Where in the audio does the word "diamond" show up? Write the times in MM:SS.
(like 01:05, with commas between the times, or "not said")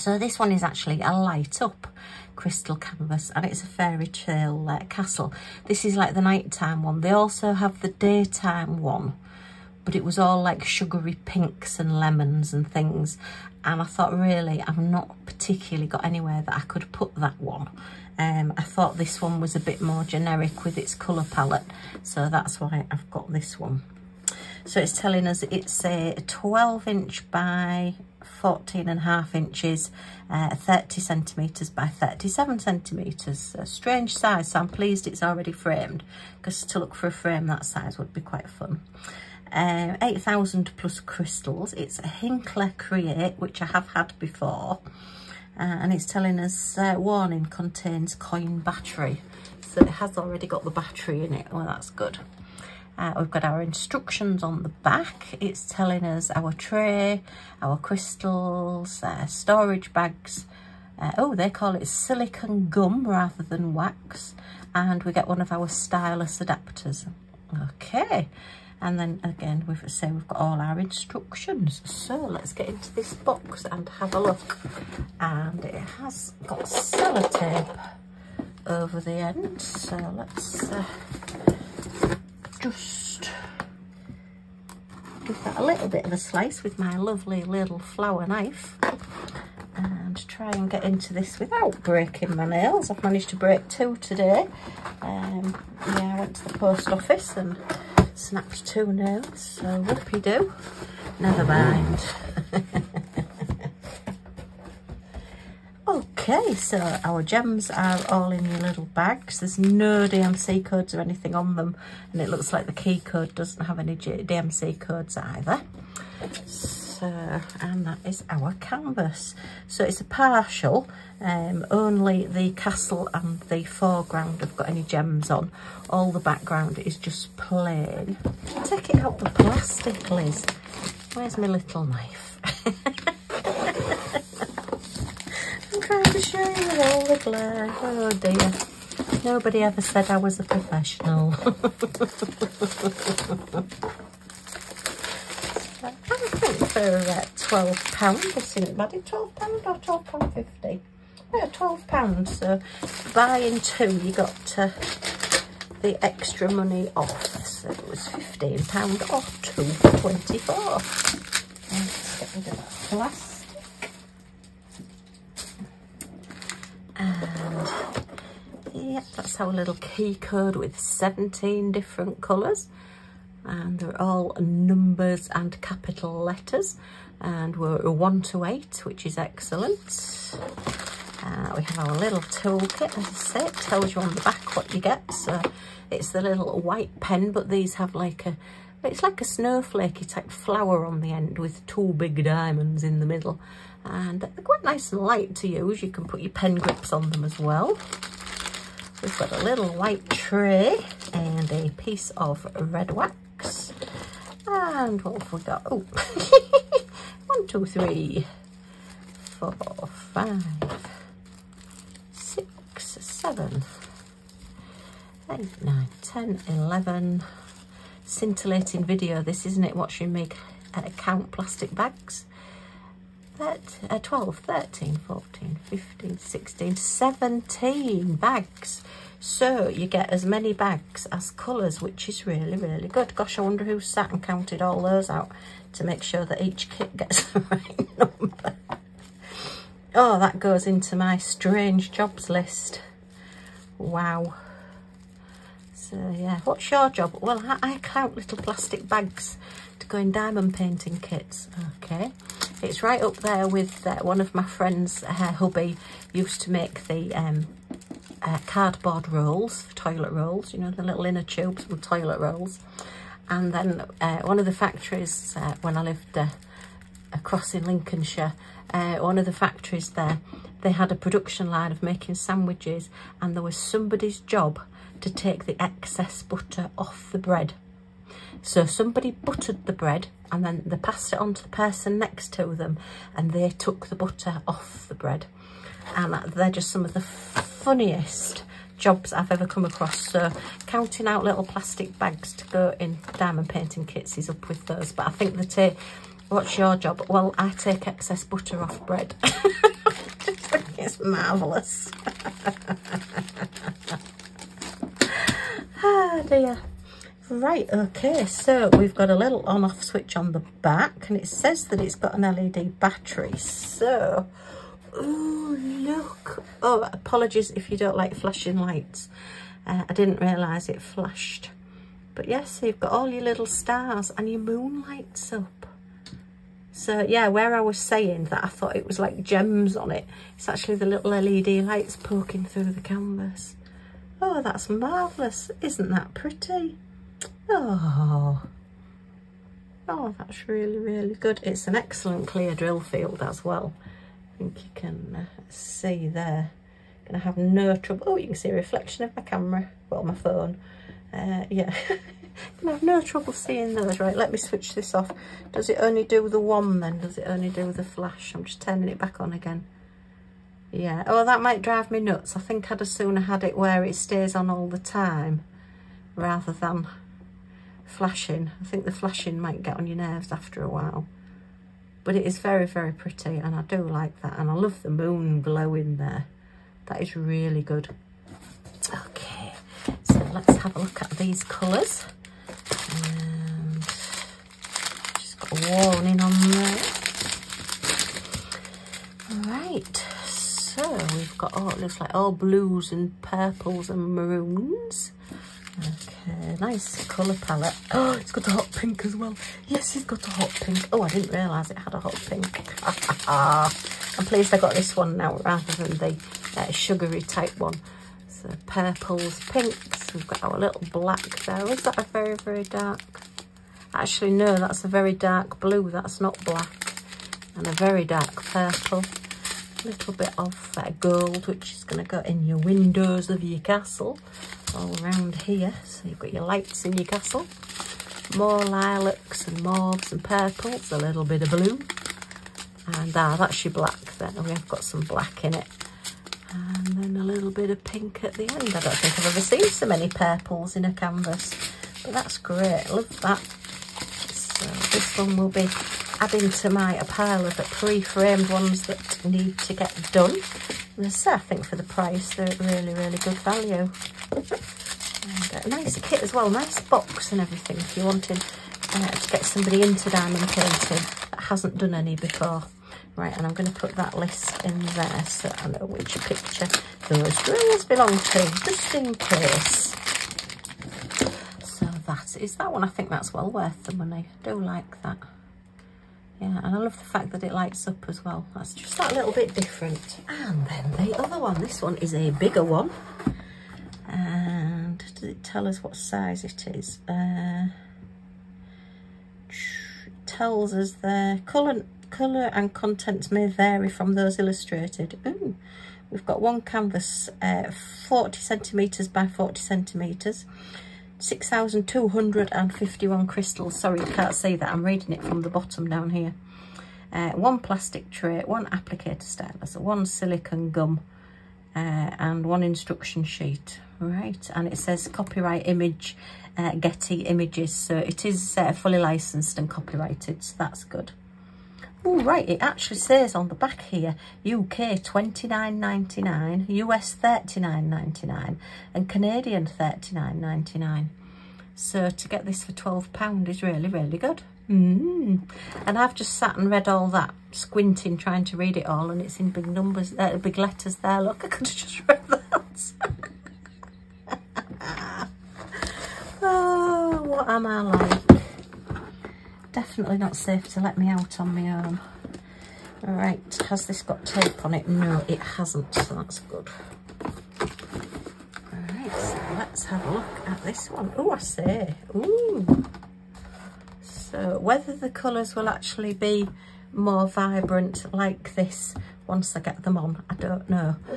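03:12, 04:10, 04:53, 07:40.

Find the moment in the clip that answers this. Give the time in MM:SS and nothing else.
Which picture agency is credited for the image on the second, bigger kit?
08:36.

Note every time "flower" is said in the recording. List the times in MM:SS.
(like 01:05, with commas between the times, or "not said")
01:27, 03:10.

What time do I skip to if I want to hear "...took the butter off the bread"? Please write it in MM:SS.
04:43.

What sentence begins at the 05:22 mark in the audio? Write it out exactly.
But yes, you've got all your little stars and your moon lights up.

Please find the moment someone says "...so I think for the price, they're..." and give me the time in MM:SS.
07:31.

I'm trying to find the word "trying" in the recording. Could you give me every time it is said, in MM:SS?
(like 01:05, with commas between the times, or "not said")
08:58.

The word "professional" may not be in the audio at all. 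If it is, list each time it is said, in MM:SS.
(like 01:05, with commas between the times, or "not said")
02:20.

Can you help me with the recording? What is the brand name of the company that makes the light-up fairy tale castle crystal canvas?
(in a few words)
Hinkler Create.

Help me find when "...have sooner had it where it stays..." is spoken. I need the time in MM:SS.
06:02.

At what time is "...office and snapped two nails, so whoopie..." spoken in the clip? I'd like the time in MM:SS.
01:36.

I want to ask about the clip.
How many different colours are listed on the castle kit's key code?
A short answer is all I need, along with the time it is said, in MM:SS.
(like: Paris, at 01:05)
17, at 02:50.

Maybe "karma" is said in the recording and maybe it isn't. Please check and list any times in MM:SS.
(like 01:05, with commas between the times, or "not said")
not said.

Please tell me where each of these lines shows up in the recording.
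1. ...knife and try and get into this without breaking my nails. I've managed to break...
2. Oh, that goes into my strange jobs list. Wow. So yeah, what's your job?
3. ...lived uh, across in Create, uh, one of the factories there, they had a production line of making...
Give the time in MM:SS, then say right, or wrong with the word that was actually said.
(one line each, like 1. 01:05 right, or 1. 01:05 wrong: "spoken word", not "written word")
1. 01:28 right
2. 03:59 right
3. 04:25 wrong: "Lincolnshire", not "Create".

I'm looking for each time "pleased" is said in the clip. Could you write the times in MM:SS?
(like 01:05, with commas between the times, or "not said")
00:34, 06:44.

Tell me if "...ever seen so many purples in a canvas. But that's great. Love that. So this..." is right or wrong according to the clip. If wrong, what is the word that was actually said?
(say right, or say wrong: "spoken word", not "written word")
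right.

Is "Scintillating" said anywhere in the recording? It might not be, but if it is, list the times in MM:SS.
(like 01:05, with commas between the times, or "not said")
03:38.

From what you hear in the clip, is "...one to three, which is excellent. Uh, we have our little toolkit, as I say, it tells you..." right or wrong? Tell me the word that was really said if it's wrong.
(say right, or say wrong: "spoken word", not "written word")
wrong: "eight", not "three".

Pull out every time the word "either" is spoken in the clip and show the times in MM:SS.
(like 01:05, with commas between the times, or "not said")
01:55.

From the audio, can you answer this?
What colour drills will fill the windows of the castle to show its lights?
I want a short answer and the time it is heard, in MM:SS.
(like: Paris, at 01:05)
gold, at 07:00.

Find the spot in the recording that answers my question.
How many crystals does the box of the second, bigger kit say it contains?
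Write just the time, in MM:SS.
08:21.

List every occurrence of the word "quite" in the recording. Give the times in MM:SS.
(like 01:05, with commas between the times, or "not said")
00:38, 03:14.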